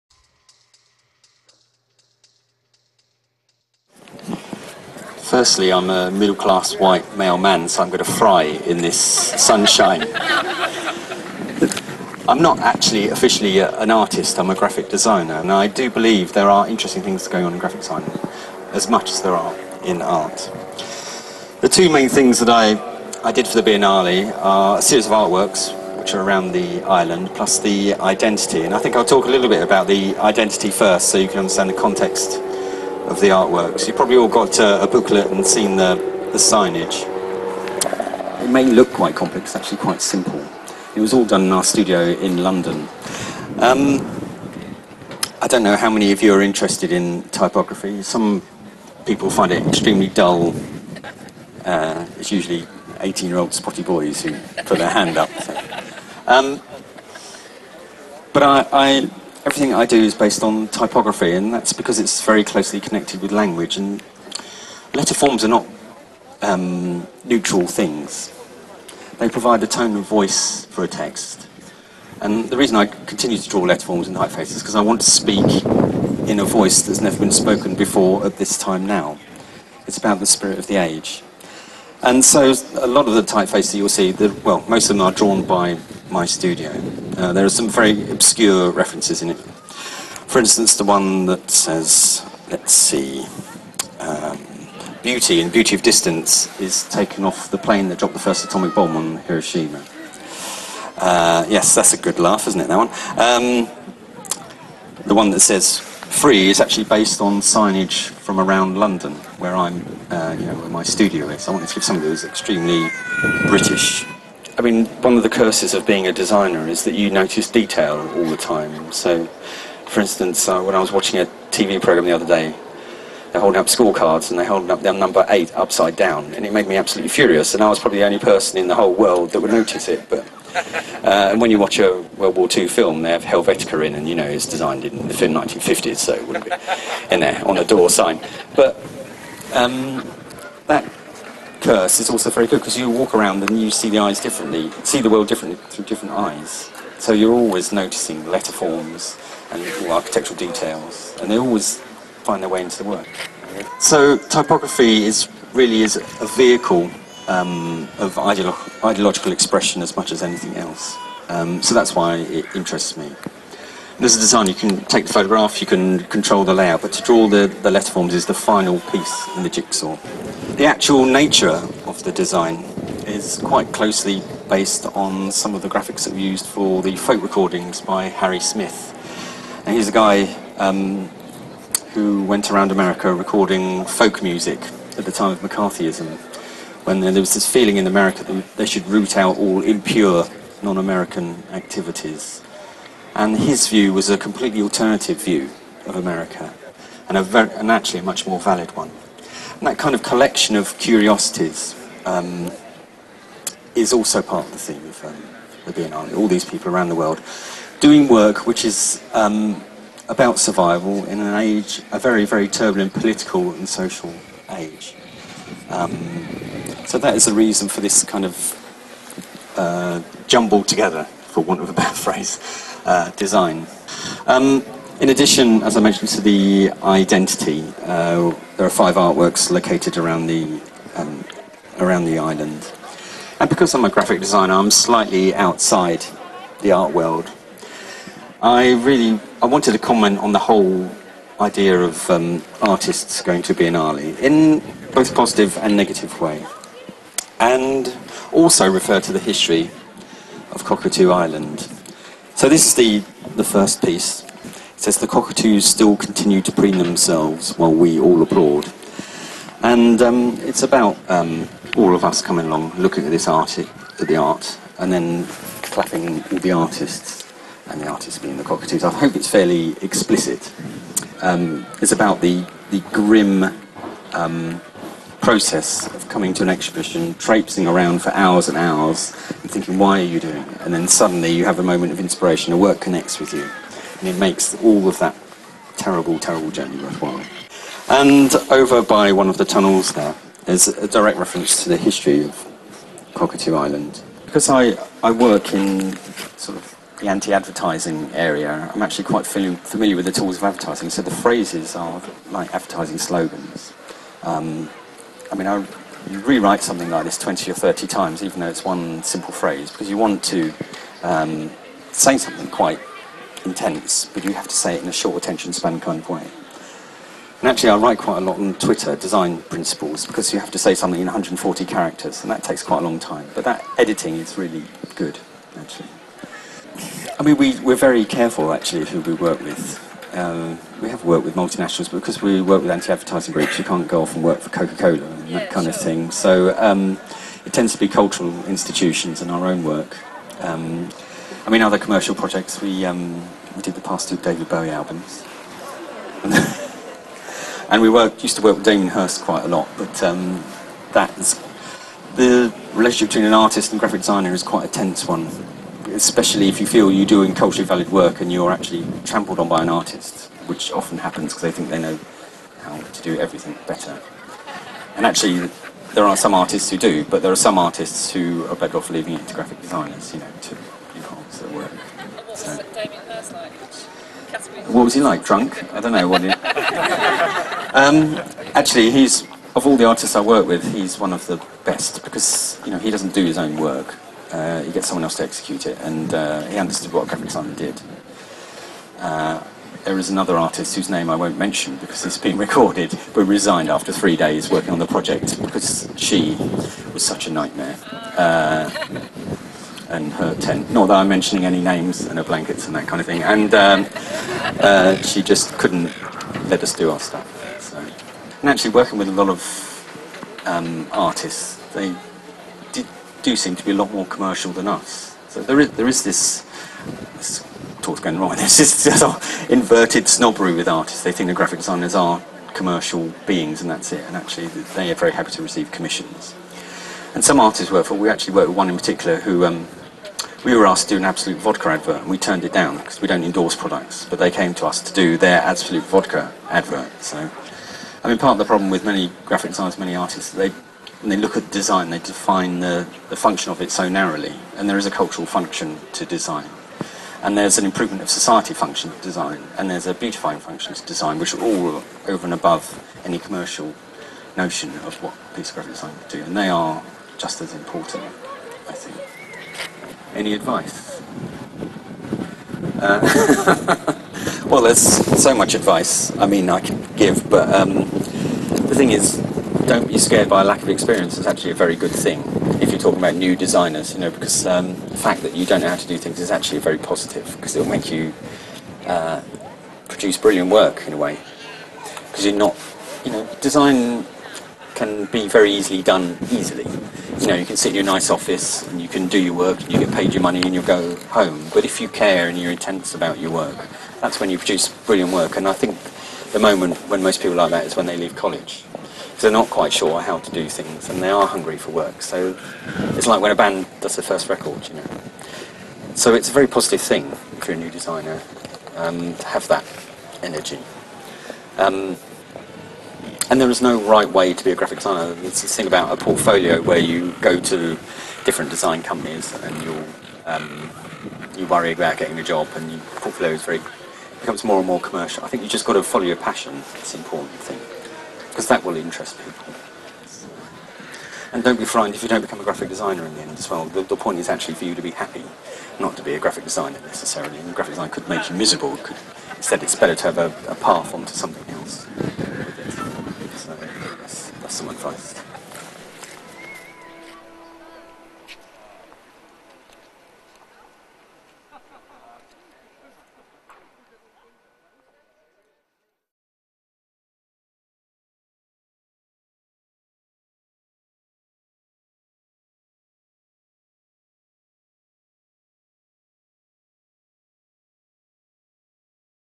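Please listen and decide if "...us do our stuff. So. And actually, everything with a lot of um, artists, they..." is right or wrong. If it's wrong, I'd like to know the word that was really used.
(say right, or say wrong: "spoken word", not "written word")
wrong: "working", not "everything".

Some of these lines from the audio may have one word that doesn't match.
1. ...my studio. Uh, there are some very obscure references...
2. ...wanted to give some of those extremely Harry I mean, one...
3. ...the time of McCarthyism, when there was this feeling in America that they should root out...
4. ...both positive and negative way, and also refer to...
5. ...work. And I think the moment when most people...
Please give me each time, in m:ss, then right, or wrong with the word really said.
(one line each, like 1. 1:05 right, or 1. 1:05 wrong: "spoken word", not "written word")
1. 1:26 right
2. 1:51 wrong: "British", not "Harry"
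3. 3:05 right
4. 4:04 right
5. 8:15 right.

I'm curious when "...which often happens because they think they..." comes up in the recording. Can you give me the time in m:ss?
6:00.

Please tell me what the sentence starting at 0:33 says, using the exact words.
You've probably all got uh, a booklet and seen the, the signage.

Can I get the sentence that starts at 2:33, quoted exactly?
So typography is really is a vehicle um, of ideolo ideological expression as much as anything else.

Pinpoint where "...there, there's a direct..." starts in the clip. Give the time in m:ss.
4:49.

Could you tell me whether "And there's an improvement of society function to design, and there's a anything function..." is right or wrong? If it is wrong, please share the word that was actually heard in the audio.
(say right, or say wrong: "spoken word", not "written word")
wrong: "beautifying", not "anything".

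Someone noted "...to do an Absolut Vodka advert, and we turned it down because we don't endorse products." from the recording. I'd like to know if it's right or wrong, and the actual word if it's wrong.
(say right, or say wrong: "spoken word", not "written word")
right.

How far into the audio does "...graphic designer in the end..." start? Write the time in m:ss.
8:52.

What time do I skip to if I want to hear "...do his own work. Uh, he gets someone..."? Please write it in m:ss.
6:23.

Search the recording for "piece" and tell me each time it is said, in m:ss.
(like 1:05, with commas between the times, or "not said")
2:48, 4:13, 7:35.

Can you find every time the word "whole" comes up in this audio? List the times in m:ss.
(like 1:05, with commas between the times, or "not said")
2:08, 4:00.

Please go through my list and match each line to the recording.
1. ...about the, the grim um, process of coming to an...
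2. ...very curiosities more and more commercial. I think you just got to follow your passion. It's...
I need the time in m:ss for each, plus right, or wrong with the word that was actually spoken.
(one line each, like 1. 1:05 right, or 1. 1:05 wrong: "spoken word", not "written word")
1. 4:31 right
2. 8:43 wrong: "becomes", not "curiosities".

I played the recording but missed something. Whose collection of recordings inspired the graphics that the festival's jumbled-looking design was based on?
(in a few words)
Harry Smith.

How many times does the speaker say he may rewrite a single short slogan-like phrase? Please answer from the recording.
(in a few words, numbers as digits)
20 or 30.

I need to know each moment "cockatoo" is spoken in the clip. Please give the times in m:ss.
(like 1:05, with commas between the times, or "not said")
4:10, 4:15, 4:28, 4:53.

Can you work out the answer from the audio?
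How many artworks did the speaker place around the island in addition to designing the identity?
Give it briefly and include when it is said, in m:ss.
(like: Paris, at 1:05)
5, at 3:48.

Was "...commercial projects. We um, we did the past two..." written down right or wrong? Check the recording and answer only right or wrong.
right.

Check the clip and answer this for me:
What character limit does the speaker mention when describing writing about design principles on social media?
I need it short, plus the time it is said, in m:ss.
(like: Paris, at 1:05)
140, at 5:21.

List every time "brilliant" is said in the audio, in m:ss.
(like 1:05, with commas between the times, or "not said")
8:00, 8:14.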